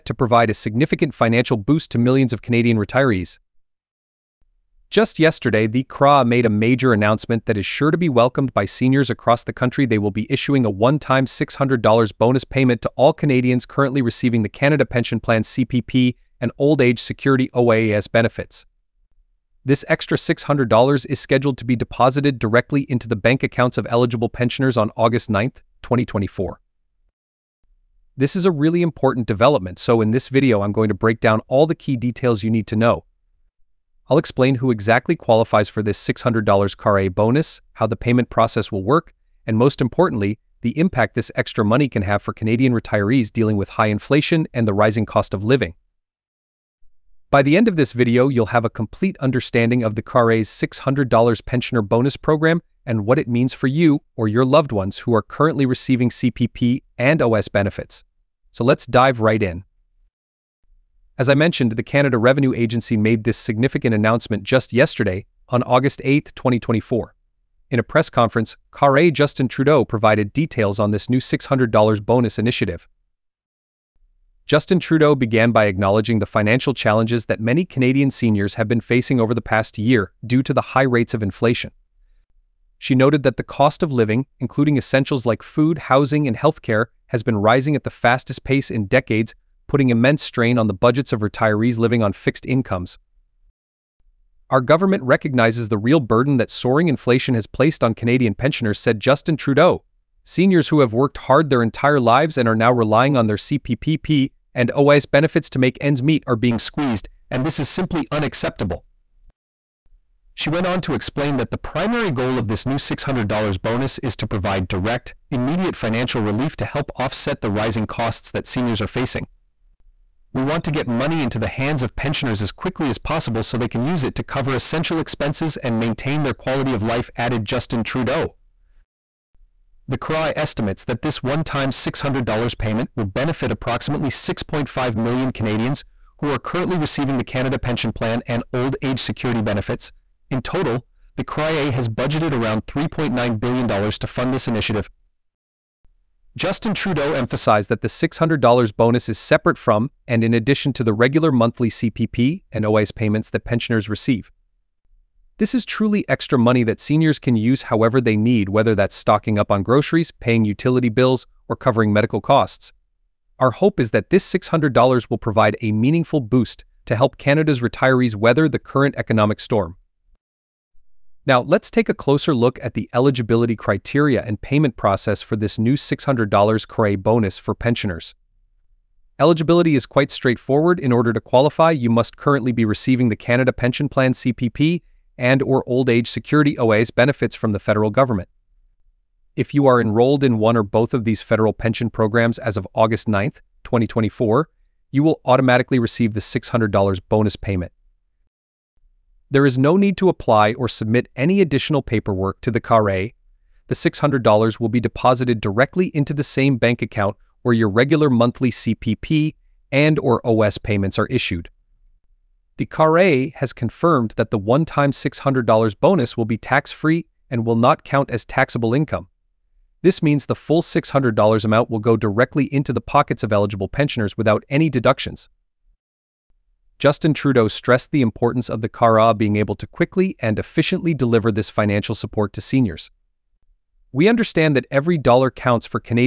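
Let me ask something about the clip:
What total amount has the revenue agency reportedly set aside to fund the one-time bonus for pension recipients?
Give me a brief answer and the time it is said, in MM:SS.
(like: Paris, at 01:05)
$3.9 billion, at 02:22.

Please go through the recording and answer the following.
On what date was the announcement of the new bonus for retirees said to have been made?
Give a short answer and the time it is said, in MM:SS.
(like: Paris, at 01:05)
August 8, 2024, at 01:05.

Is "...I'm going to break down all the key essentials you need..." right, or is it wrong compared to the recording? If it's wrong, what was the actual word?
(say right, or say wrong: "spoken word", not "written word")
wrong: "details", not "essentials".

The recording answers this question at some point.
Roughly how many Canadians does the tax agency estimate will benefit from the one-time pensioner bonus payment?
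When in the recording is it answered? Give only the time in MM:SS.
02:14.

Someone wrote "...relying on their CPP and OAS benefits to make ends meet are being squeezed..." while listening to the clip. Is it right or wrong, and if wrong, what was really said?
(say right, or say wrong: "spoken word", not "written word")
right.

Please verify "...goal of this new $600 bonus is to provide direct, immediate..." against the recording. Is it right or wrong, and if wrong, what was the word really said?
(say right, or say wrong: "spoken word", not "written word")
right.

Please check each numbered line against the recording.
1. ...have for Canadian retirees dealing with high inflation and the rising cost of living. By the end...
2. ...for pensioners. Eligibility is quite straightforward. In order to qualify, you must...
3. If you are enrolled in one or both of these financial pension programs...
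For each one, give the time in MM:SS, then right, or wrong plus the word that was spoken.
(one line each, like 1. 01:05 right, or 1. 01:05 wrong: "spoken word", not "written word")
1. 00:42 right
2. 02:57 right
3. 03:09 wrong: "federal", not "financial".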